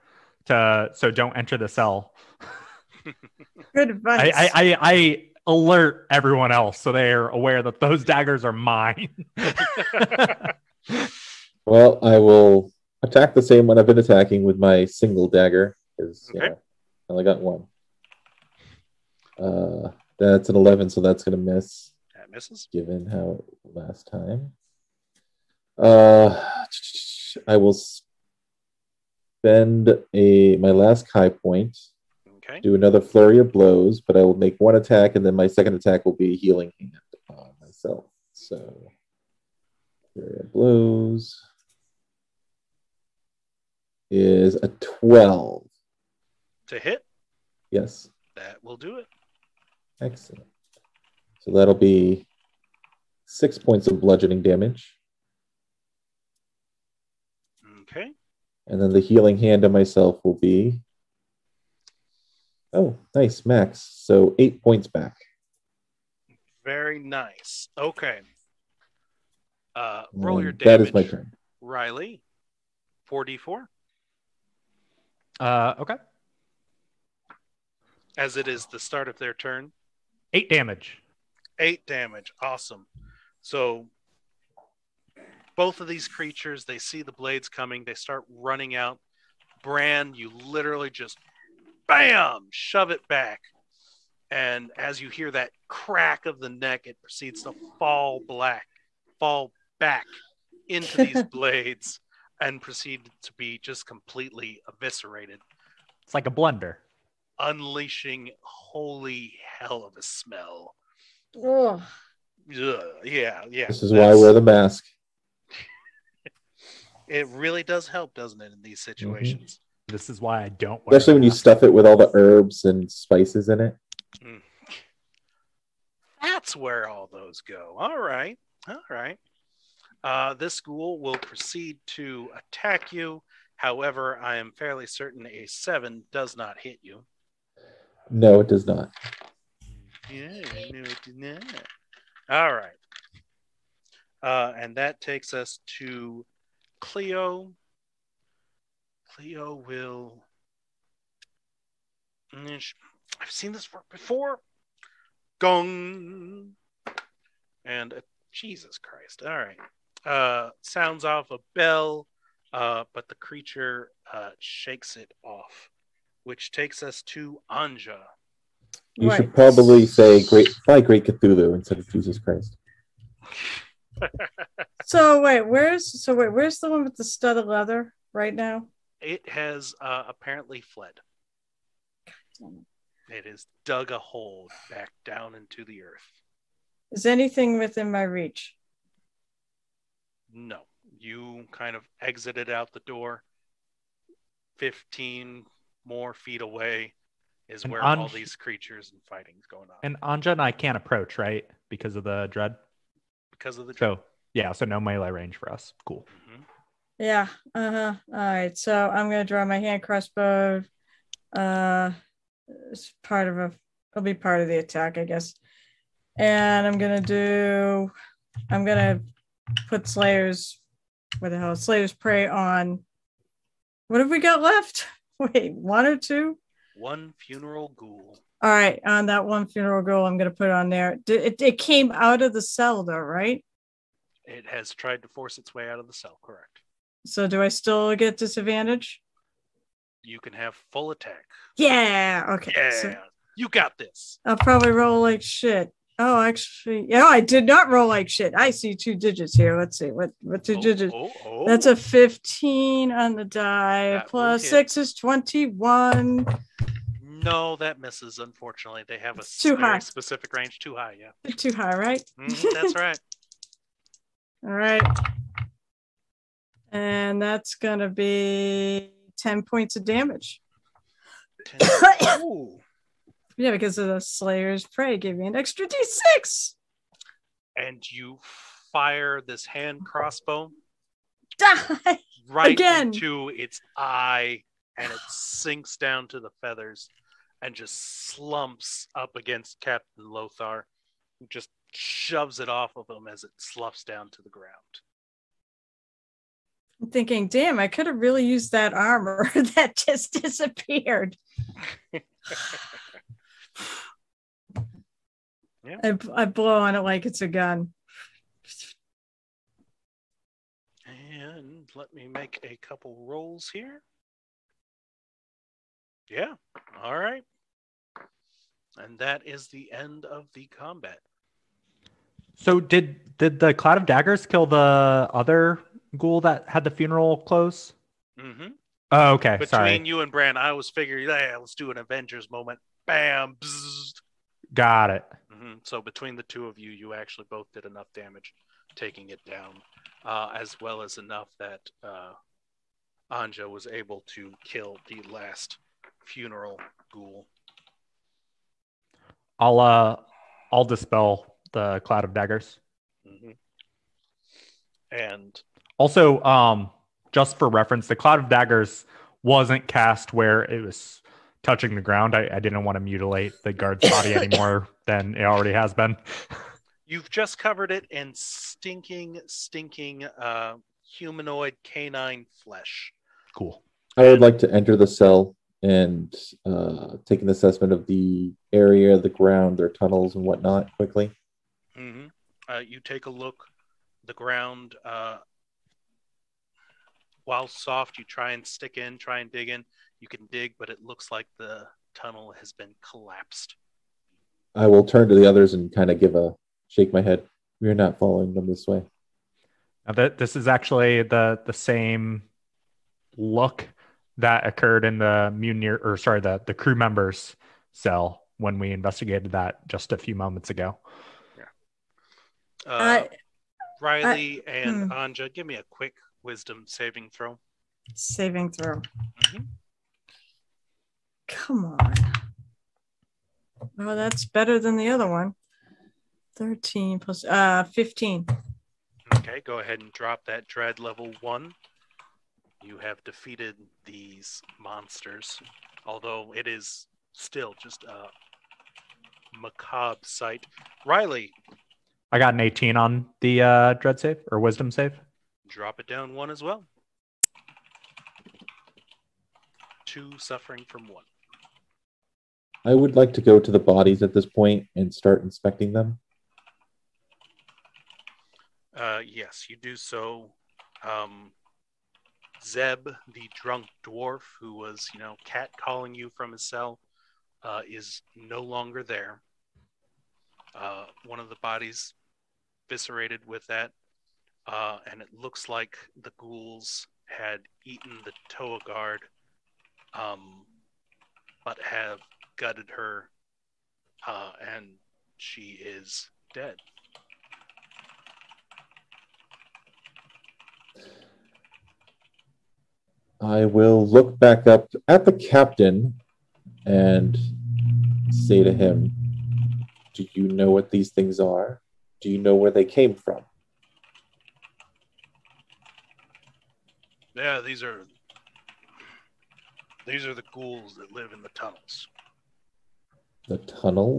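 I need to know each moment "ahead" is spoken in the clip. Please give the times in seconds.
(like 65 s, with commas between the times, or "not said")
429 s.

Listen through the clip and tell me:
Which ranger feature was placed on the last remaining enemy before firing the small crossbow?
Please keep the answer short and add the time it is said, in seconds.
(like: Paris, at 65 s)
Slayer's Prey, at 221 s.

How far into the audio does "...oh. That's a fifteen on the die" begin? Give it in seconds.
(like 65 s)
251 s.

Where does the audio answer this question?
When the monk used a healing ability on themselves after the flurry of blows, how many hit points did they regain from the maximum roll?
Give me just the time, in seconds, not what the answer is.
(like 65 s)
64 s.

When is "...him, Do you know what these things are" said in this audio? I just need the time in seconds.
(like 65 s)
498 s.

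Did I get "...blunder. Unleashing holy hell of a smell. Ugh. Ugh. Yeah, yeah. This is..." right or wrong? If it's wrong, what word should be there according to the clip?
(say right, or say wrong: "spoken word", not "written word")
right.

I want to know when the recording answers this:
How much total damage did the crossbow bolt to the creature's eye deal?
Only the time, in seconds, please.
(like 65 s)
269 s.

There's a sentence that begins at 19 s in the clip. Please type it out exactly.
Uh, that's an eleven, so that's gonna miss.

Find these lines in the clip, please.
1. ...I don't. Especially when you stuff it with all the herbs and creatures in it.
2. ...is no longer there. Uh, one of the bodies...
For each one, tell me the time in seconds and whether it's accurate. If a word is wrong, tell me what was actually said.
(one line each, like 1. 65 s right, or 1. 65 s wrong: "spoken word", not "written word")
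1. 120 s wrong: "spices", not "creatures"
2. 467 s right.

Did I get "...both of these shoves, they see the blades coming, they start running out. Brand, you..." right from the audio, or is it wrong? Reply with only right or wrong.
wrong.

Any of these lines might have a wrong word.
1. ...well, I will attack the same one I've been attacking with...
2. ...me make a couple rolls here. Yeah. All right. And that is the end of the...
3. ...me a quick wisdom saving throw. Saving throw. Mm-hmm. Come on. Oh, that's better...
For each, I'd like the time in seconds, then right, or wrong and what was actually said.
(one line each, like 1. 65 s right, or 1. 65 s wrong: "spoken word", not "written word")
1. 11 s right
2. 311 s right
3. 415 s right.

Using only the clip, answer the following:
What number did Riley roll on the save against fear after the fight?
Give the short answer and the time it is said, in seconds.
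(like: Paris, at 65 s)
18, at 442 s.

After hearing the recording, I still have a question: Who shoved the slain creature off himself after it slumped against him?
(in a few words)
Captain Lothar.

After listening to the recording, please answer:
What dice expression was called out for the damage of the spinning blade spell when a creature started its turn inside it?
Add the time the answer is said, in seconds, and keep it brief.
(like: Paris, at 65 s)
4d4, at 73 s.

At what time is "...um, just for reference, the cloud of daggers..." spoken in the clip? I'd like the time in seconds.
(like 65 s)
356 s.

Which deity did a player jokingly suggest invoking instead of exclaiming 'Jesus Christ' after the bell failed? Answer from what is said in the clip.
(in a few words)
Cthulhu.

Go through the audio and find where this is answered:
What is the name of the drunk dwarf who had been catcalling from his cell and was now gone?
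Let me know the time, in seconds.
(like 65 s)
462 s.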